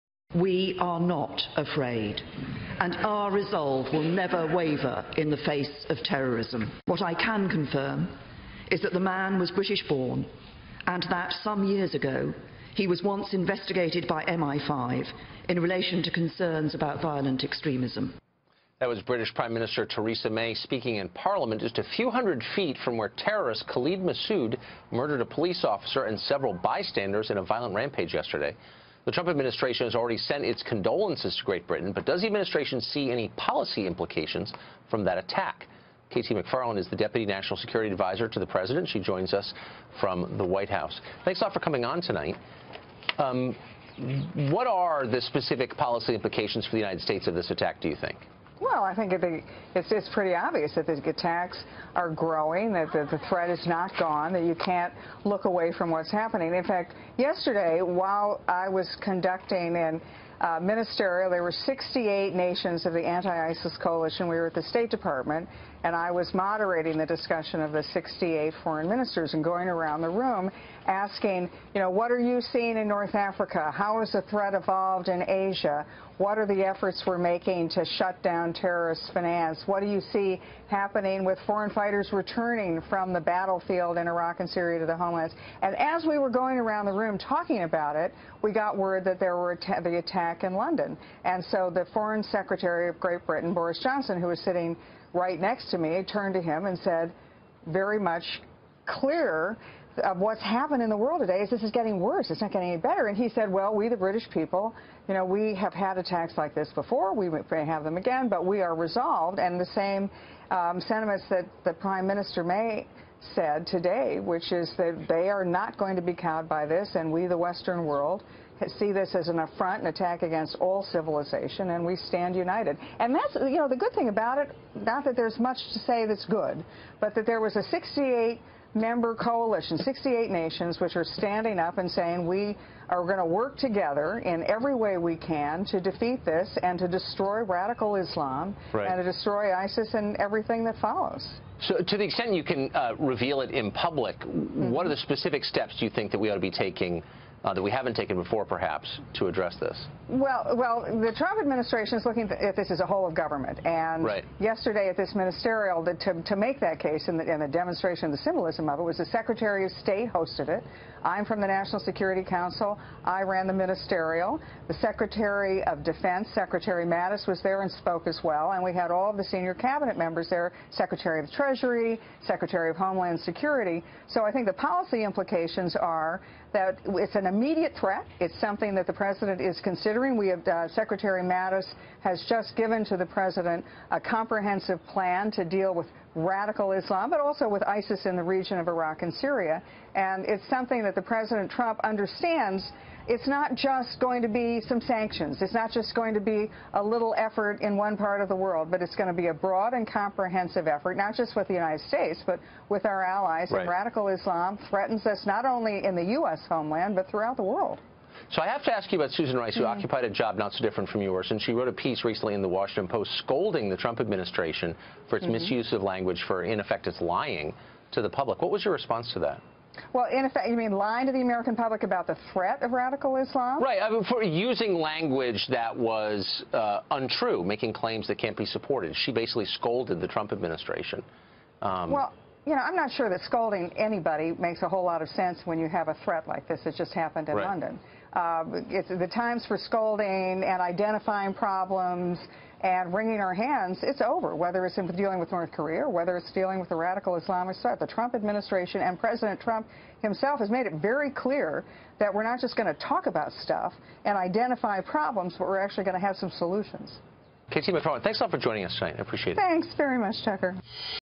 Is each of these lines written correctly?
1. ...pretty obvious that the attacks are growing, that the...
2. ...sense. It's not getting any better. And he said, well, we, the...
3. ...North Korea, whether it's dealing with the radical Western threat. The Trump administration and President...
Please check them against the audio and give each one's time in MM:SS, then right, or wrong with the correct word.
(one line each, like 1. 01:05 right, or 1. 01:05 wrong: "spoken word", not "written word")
1. 00:50 right
2. 01:41 wrong: "worse", not "sense"
3. 04:05 wrong: "Islamic", not "Western".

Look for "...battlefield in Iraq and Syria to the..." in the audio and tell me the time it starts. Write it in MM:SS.
01:23.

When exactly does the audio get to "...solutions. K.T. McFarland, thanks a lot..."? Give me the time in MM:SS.
04:16.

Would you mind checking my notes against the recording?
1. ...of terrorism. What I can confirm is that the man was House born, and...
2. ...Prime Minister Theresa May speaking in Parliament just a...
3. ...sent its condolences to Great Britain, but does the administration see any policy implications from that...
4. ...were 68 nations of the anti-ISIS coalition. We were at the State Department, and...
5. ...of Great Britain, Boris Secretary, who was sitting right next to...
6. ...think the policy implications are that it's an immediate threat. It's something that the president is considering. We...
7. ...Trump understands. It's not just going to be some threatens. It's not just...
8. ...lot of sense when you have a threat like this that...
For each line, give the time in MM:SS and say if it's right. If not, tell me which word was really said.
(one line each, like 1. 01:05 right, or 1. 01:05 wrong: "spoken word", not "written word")
1. 00:05 wrong: "British", not "House"
2. 00:19 right
3. 00:30 right
4. 01:01 right
5. 01:32 wrong: "Johnson", not "Secretary"
6. 02:54 right
7. 03:11 wrong: "sanctions", not "threatens"
8. 03:54 right.